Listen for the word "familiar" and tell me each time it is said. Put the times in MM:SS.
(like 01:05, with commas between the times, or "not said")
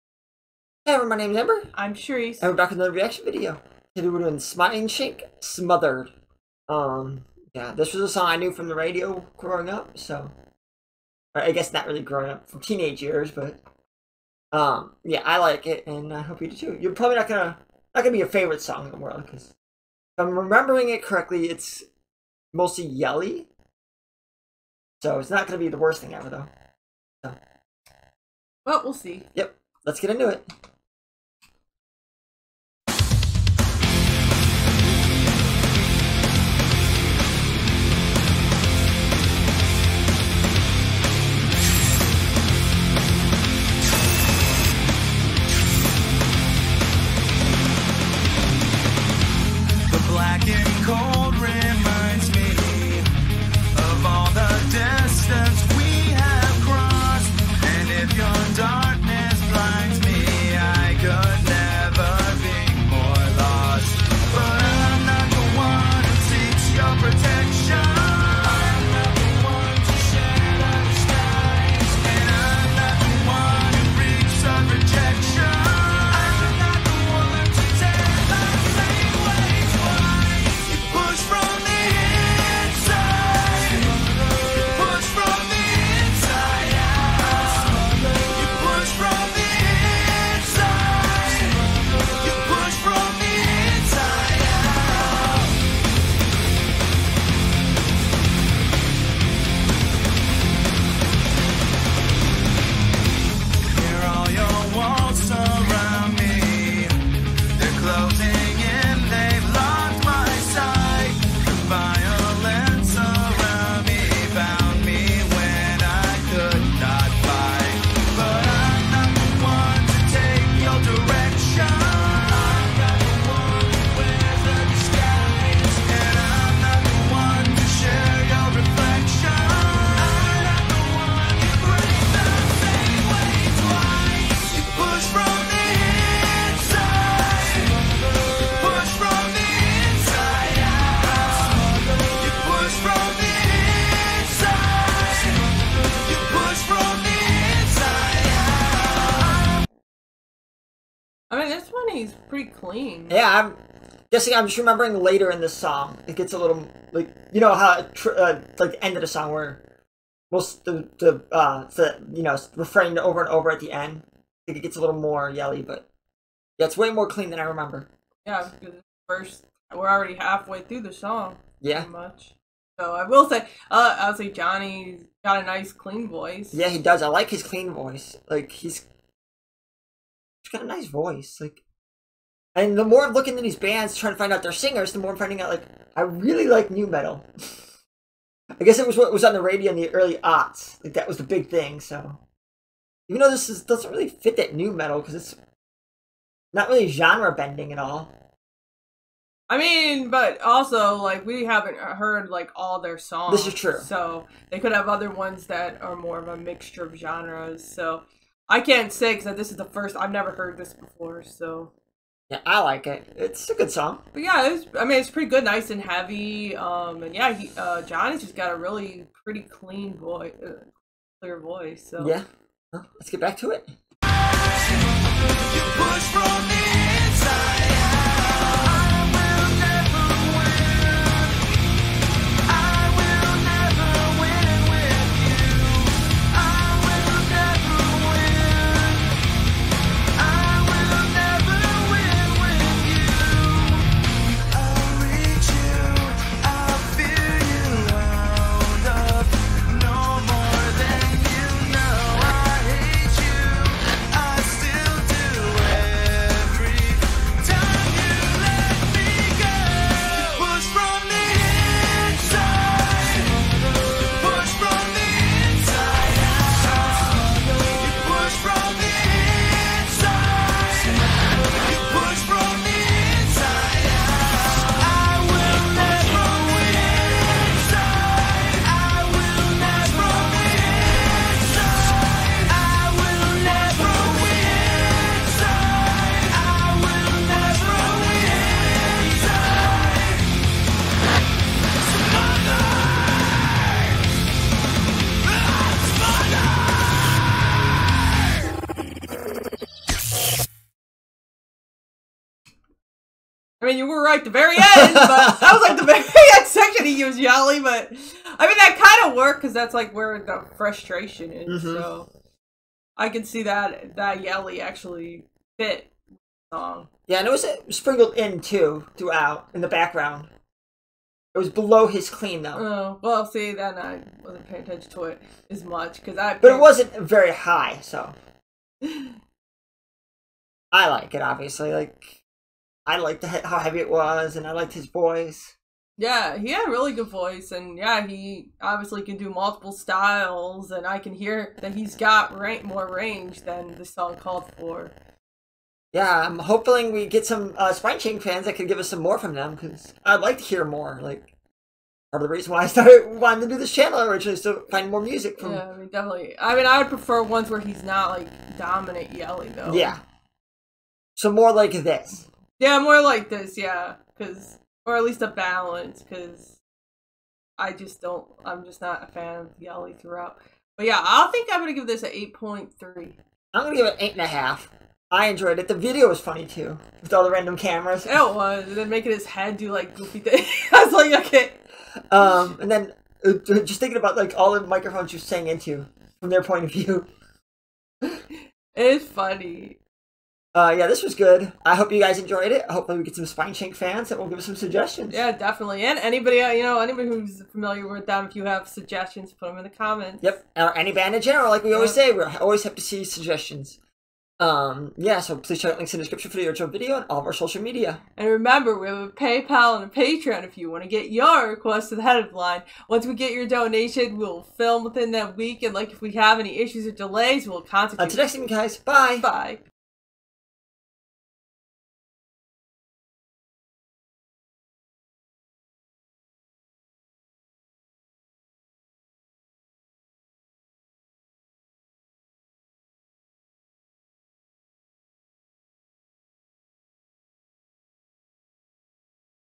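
06:37.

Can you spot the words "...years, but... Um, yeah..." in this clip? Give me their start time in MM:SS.
00:12.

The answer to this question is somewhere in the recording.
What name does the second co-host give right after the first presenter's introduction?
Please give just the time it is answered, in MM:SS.
00:01.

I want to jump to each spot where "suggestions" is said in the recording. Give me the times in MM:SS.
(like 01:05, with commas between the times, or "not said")
06:34, 06:38, 06:43.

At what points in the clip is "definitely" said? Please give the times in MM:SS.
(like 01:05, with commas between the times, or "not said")
05:55, 06:35.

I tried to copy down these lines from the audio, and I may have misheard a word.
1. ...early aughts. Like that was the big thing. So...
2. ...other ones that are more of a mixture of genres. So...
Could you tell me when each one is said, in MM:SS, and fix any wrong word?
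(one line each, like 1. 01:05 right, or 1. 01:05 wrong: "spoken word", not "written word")
1. 03:09 right
2. 03:24 right.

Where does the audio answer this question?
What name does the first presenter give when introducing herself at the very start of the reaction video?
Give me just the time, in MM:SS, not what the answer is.
00:01.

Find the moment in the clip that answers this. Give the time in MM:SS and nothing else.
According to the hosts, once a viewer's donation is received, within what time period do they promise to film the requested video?
06:54.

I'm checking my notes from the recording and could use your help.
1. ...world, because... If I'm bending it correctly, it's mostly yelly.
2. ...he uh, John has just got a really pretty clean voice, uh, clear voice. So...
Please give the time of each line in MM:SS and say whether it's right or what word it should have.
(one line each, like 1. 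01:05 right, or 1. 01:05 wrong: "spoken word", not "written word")
1. 00:18 wrong: "remembering", not "bending"
2. 03:37 right.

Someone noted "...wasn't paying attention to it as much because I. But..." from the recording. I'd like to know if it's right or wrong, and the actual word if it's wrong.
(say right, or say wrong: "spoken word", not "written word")
right.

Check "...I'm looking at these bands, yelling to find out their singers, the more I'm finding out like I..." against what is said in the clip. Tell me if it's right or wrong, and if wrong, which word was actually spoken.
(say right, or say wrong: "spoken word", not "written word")
wrong: "trying", not "yelling".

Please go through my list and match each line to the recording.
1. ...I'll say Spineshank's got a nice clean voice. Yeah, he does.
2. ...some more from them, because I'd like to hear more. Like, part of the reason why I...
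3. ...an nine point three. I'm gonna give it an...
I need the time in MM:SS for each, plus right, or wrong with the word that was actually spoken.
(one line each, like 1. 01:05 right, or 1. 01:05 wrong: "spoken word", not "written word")
1. 02:53 wrong: "Johnny", not "Spineshank"
2. 05:48 right
3. 06:12 wrong: "eight", not "nine".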